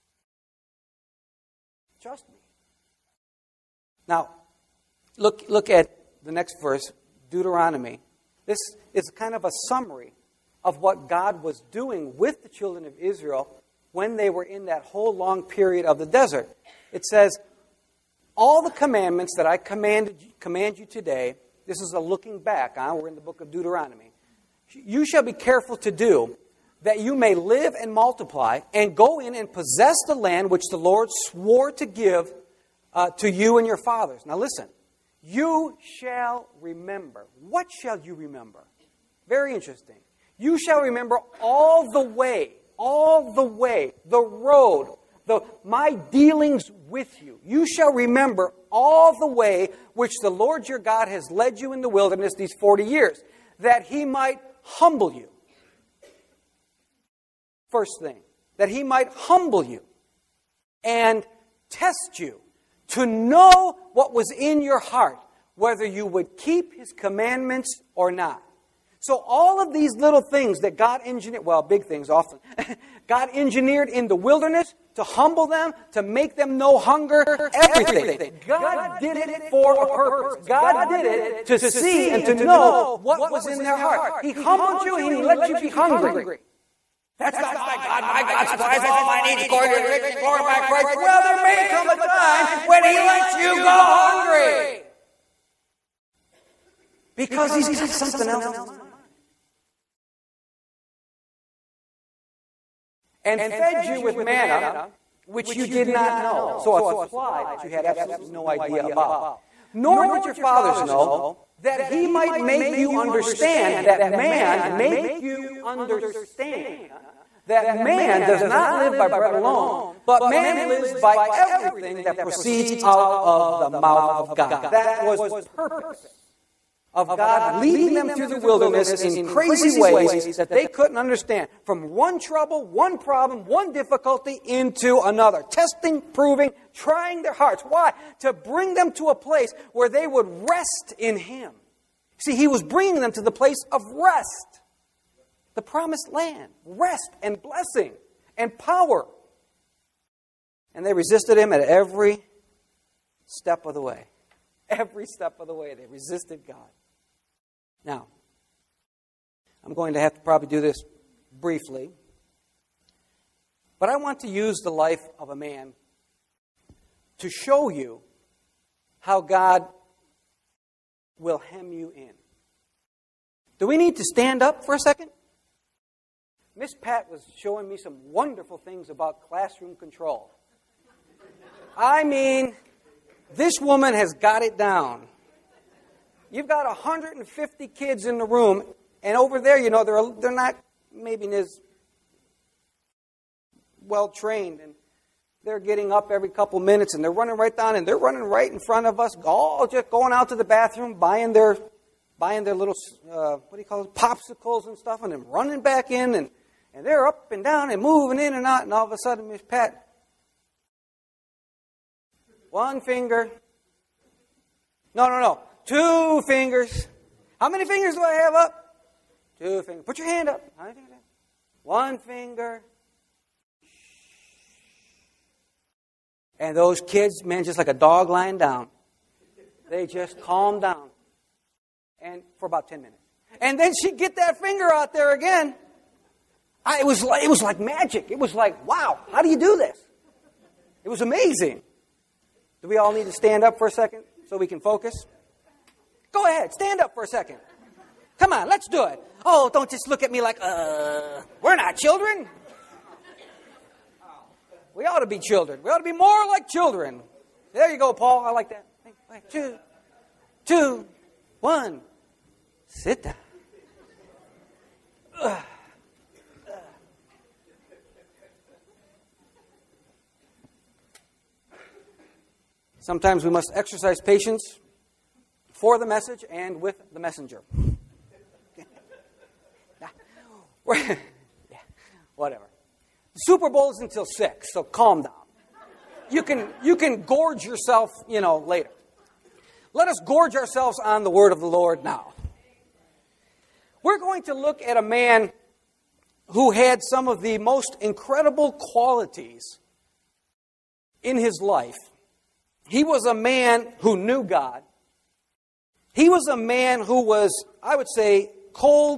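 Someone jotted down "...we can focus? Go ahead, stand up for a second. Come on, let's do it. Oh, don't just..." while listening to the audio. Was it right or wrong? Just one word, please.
right.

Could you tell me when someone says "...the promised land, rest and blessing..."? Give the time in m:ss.
2:25.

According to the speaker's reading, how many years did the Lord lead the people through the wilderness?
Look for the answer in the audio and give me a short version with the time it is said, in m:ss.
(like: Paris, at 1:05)
40, at 0:52.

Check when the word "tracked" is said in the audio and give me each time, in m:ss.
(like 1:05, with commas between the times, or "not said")
not said.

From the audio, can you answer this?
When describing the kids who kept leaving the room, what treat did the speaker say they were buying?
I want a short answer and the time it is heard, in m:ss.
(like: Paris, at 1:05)
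popsicles, at 3:23.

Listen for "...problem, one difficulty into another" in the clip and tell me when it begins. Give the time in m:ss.
2:12.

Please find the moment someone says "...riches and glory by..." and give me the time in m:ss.
1:29.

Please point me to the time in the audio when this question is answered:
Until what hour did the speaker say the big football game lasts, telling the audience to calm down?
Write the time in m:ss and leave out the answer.
4:44.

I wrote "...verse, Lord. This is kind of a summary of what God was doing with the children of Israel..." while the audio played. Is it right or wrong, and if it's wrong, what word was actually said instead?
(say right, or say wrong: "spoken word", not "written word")
wrong: "Deuteronomy", not "Lord".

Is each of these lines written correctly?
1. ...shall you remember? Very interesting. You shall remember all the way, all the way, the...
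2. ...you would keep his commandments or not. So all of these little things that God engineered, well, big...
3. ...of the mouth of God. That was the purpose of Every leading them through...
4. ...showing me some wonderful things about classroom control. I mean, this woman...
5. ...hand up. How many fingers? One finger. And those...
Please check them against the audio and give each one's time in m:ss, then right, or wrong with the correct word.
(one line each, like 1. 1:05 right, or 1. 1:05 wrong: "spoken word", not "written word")
1. 0:37 right
2. 1:05 right
3. 2:03 wrong: "God", not "Every"
4. 2:57 right
5. 3:40 right.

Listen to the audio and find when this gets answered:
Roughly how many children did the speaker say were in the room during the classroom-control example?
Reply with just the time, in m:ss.
3:06.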